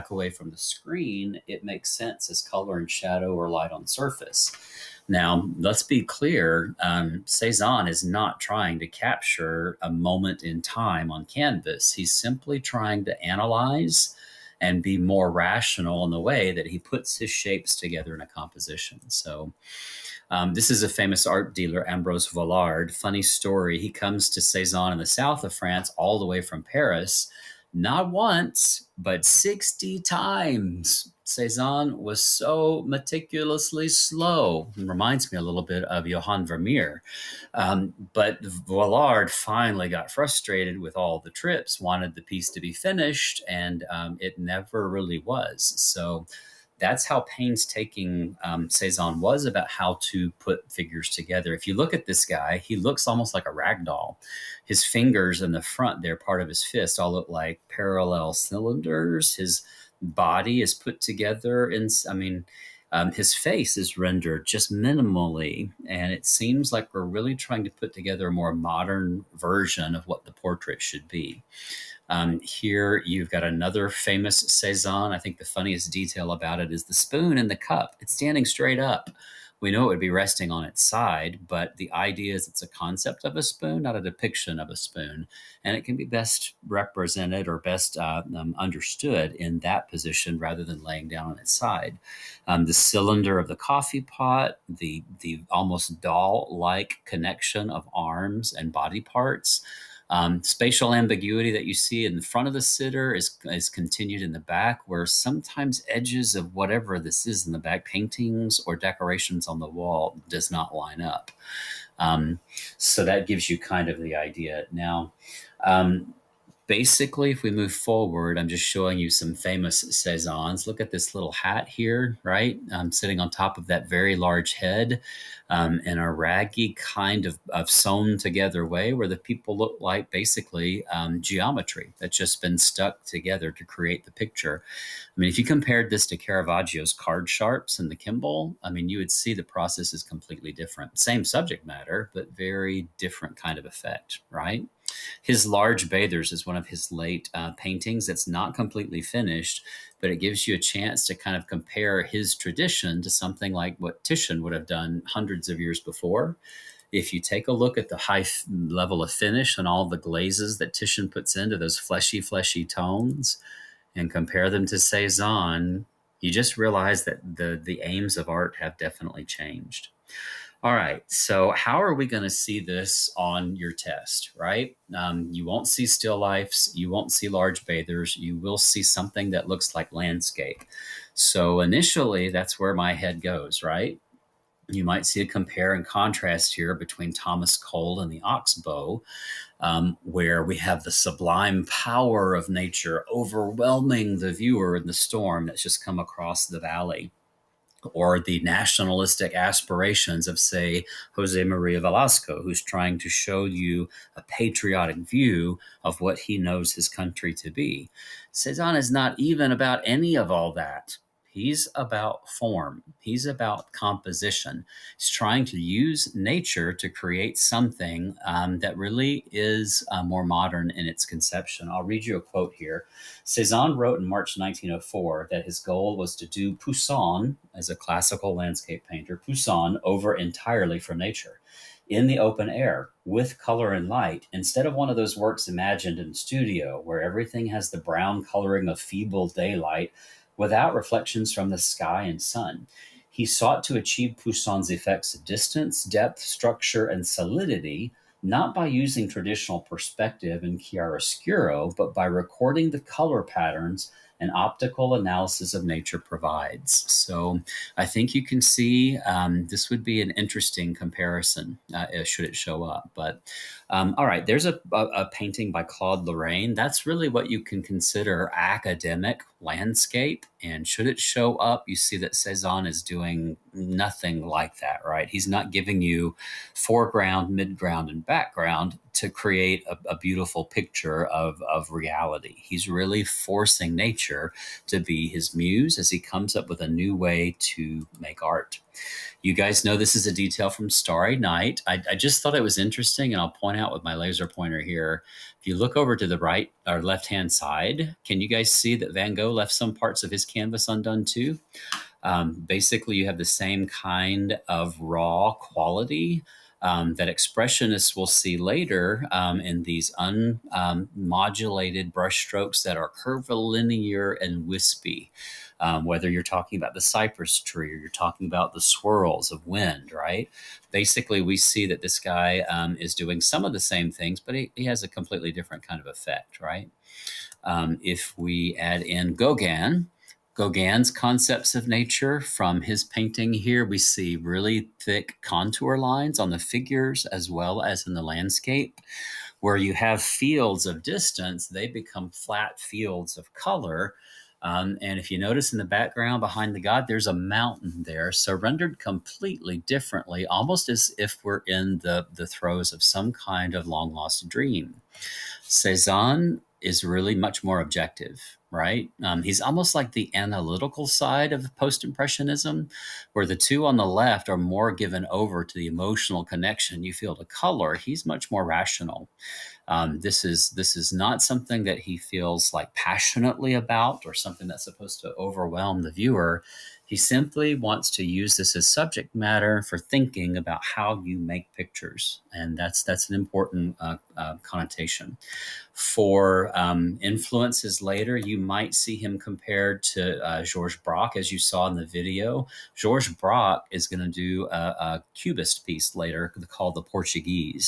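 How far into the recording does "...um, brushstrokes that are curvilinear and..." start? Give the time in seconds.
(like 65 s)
311 s.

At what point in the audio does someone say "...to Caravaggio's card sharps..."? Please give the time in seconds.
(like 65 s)
136 s.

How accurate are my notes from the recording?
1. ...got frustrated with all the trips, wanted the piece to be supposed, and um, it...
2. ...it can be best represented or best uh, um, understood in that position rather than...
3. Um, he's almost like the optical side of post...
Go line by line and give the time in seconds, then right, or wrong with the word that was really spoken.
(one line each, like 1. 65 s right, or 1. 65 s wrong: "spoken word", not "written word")
1. 39 s wrong: "finished", not "supposed"
2. 85 s right
3. 359 s wrong: "analytical", not "optical".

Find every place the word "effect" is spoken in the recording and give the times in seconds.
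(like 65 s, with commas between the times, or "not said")
143 s, 244 s, 325 s.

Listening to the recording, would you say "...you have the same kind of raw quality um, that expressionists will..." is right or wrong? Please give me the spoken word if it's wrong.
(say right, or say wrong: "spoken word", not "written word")
right.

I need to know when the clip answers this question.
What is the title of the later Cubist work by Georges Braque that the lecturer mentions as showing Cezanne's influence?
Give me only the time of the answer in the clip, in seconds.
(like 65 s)
396 s.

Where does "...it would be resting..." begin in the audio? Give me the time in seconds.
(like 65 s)
79 s.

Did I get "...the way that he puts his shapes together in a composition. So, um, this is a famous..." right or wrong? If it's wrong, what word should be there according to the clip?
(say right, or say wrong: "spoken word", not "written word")
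right.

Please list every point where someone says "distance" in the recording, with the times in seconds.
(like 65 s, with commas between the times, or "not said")
245 s, 340 s.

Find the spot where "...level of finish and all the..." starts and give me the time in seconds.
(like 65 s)
158 s.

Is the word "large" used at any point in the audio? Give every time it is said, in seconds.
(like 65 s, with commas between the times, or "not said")
124 s, 145 s, 177 s.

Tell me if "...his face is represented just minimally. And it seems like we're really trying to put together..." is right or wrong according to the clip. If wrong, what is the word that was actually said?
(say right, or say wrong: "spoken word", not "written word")
wrong: "rendered", not "represented".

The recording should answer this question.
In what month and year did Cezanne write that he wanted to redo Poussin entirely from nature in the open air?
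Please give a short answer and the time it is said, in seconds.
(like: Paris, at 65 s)
March 1904, at 224 s.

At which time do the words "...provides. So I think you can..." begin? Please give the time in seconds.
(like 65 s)
255 s.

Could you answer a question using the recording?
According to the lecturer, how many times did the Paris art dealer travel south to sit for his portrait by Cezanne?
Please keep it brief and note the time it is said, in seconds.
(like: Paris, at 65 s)
60, at 29 s.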